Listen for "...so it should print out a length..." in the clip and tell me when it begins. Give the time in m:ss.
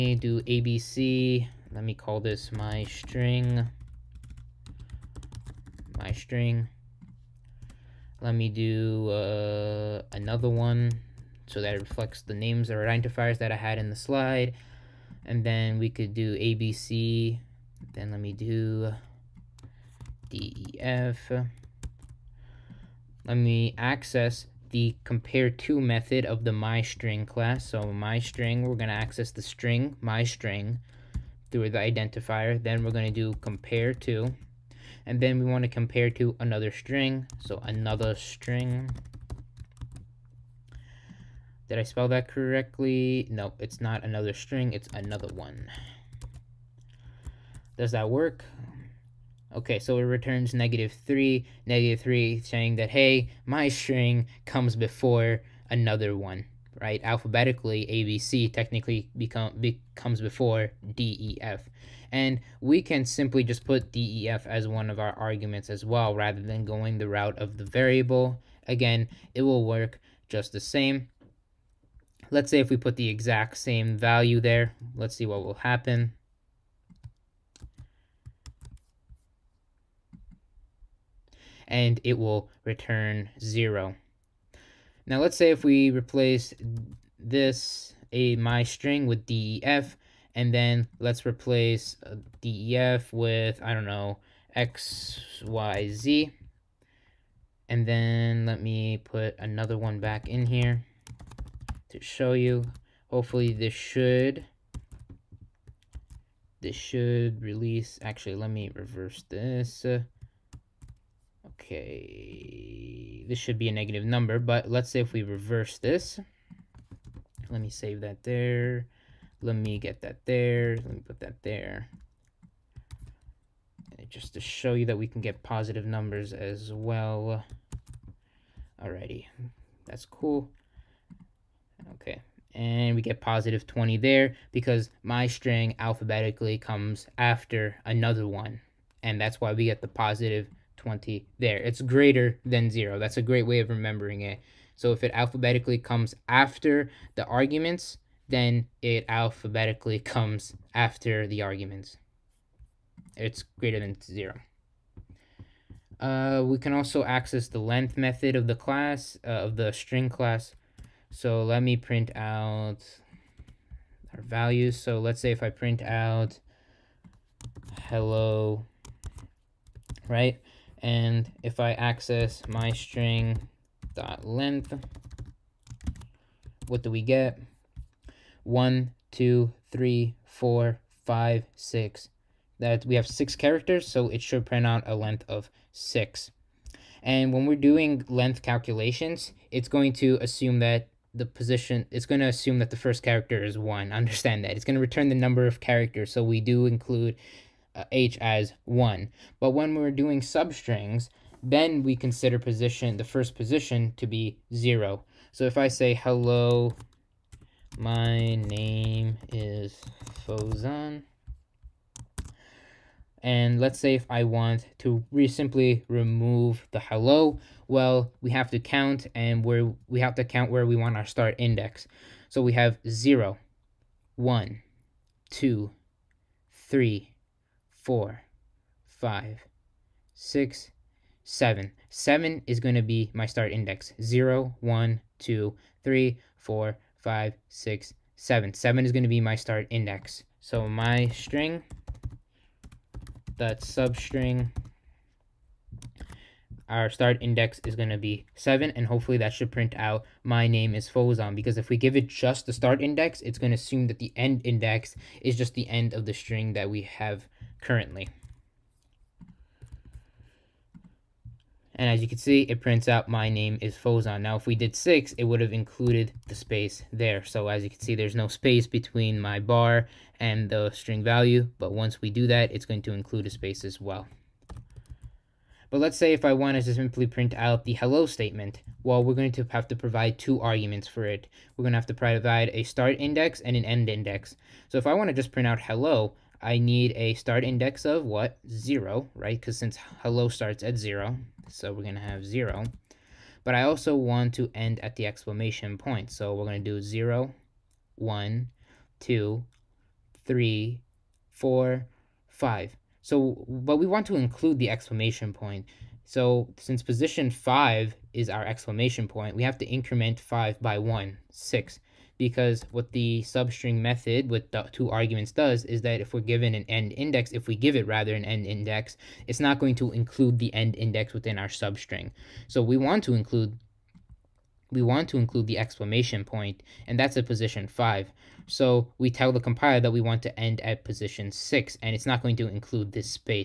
3:03.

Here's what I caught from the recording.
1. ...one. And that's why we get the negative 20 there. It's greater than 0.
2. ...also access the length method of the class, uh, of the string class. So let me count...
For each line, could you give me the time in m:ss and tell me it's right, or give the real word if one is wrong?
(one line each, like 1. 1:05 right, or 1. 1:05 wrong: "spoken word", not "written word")
1. 2:18 wrong: "positive", not "negative"
2. 2:36 wrong: "print", not "count".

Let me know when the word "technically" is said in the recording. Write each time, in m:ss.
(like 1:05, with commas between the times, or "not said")
0:58.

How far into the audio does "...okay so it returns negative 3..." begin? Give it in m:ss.
0:49.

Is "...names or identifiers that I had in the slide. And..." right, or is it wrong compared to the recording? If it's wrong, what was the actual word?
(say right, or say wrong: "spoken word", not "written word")
right.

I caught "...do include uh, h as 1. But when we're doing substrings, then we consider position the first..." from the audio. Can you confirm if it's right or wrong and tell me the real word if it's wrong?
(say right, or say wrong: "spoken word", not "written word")
right.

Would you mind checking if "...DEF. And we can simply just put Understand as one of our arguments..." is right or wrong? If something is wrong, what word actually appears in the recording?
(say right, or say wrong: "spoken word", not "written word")
wrong: "DEF", not "Understand".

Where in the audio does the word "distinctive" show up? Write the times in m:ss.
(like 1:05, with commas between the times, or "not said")
not said.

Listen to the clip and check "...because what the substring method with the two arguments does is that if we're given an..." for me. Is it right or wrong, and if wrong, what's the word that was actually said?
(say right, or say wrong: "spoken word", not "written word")
right.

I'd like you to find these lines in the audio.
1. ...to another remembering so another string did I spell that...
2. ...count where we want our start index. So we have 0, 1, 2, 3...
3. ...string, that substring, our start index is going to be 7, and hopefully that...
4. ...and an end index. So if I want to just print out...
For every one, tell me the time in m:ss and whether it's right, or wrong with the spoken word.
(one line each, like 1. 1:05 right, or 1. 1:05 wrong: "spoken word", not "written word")
1. 0:36 wrong: "string", not "remembering"
2. 3:40 right
3. 4:01 right
4. 4:43 right.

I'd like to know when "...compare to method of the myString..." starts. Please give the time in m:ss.
0:25.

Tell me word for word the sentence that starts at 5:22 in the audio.
So we want to include we want to include the exclamation point, and that's at position 5.